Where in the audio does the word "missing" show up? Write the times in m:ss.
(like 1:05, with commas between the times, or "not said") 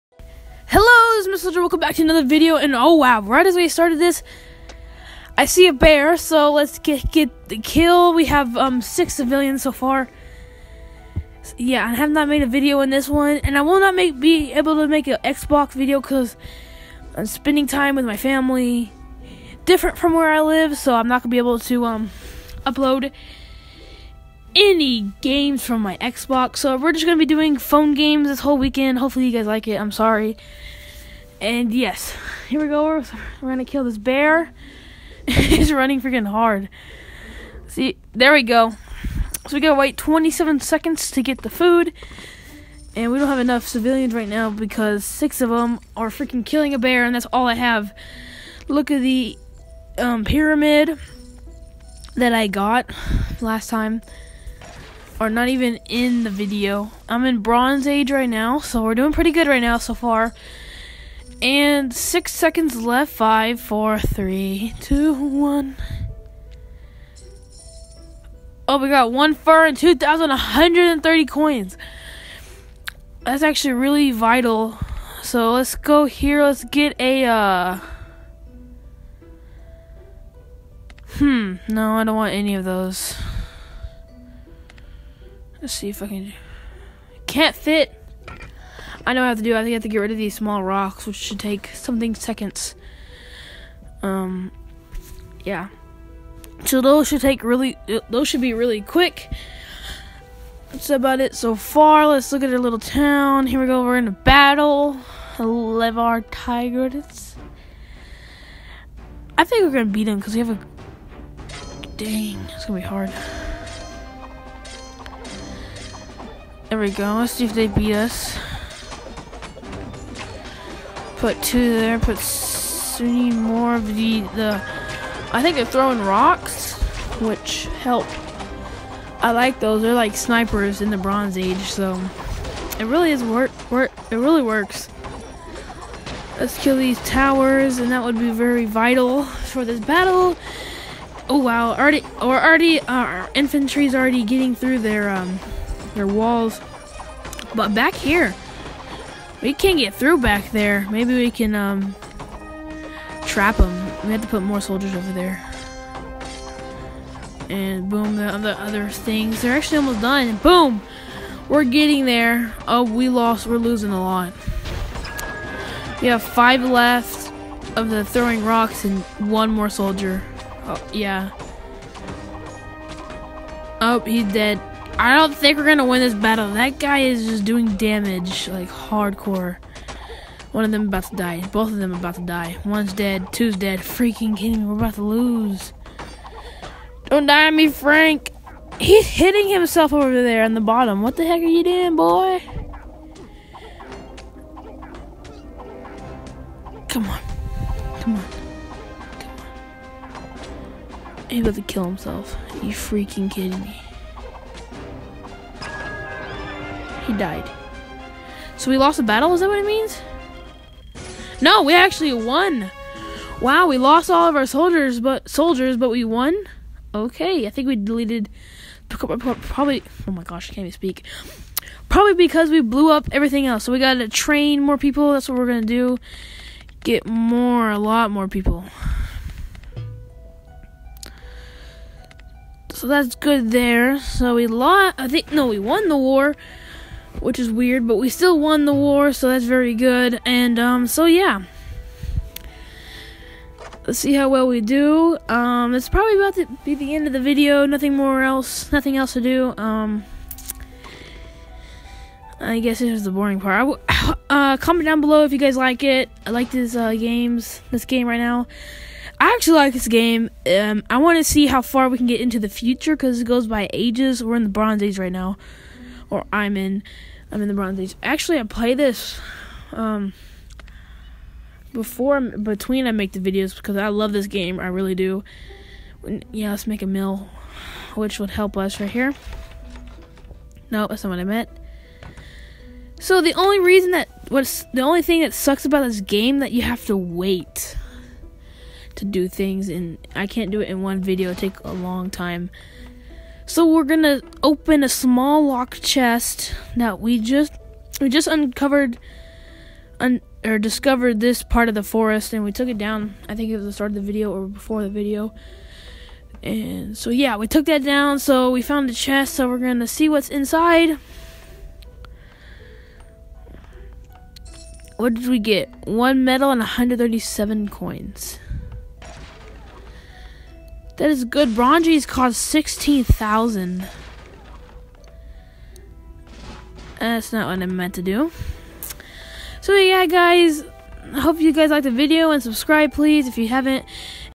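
not said.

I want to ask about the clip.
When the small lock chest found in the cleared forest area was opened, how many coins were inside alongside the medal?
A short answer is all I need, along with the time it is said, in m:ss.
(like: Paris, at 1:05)
137, at 5:16.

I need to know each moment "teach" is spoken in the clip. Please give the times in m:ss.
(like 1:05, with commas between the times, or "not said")
not said.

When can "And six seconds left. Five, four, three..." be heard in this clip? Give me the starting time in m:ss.
1:01.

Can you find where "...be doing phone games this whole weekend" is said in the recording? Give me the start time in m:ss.
0:27.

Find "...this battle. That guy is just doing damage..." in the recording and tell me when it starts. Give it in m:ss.
2:56.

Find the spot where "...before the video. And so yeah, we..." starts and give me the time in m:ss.
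5:04.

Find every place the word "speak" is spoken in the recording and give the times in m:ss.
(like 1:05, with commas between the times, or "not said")
3:40.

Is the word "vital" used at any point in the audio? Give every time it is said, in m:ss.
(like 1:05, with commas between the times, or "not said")
1:14, 2:18.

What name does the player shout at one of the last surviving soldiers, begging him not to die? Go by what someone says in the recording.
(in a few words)
Frank.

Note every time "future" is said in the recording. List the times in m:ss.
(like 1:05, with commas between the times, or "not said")
4:22.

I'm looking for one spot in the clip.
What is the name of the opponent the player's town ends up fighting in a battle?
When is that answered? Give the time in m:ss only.
1:45.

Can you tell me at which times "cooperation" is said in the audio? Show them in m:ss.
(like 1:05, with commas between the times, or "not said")
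not said.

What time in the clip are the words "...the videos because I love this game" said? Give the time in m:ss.
4:33.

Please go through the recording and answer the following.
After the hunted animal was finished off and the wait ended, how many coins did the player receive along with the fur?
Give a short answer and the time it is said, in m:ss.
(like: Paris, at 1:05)
2,130, at 1:09.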